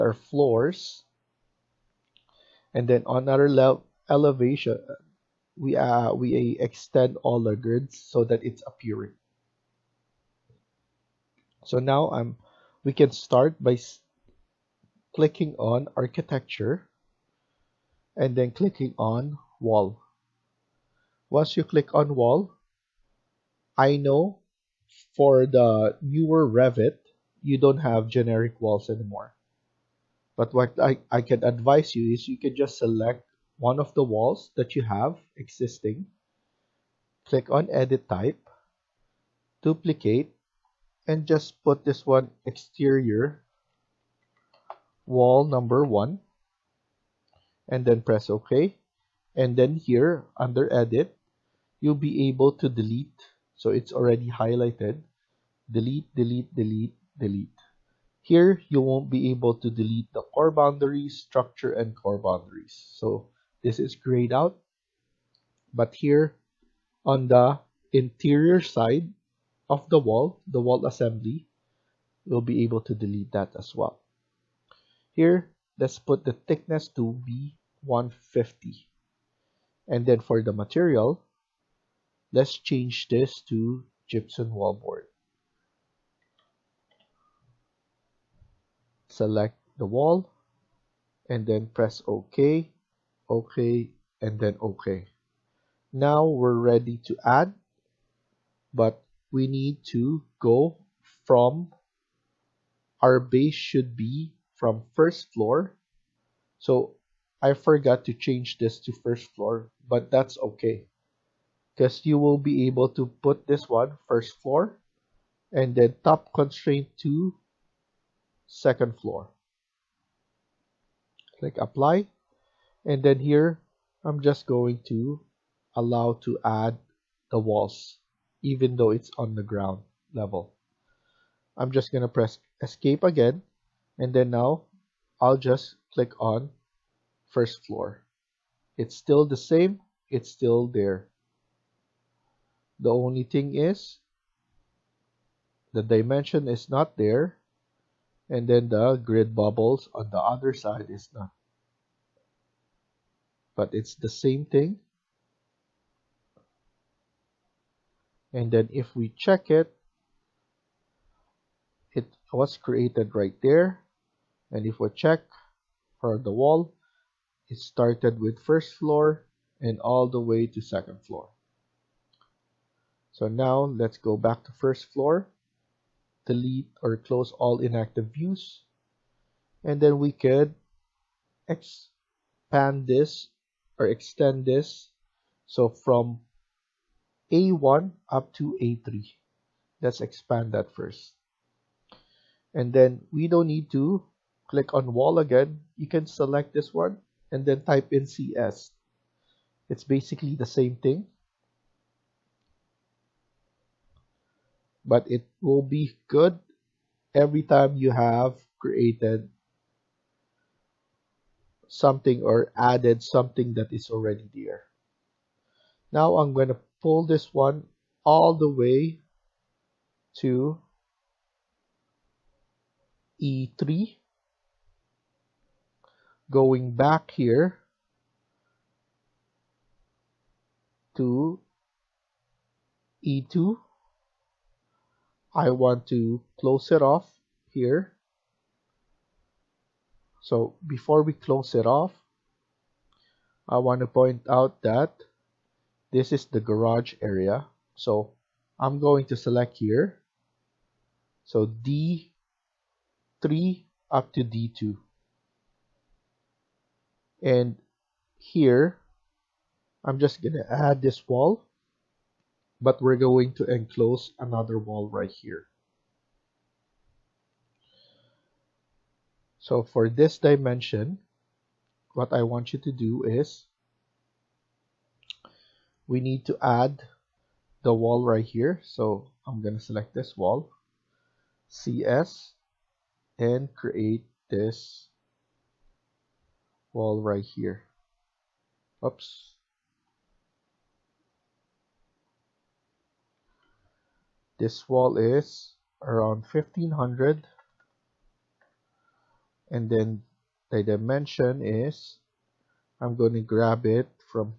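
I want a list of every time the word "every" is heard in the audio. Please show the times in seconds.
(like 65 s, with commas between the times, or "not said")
207 s.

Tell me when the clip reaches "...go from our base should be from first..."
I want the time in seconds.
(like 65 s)
100 s.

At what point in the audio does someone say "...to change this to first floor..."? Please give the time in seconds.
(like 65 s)
108 s.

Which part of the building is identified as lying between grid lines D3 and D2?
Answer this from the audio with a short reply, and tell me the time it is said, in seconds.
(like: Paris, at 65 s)
Garage, at 246 s.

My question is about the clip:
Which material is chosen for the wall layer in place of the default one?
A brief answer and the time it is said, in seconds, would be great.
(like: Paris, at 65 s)
Gypsum wallboard, at 84 s.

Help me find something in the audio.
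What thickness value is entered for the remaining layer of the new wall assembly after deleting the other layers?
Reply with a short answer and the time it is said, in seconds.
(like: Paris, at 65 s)
150, at 77 s.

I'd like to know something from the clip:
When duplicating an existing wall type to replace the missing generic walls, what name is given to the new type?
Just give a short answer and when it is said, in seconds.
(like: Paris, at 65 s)
Exterior wall number one, at 42 s.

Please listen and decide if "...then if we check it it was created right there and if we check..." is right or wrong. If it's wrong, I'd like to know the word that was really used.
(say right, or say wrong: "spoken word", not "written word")
right.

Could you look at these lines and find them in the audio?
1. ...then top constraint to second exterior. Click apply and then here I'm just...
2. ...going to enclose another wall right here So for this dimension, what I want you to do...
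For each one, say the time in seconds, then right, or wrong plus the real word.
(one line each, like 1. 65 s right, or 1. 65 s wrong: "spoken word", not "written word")
1. 115 s wrong: "floor", not "exterior"
2. 262 s right.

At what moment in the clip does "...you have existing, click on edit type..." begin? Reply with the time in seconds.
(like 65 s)
34 s.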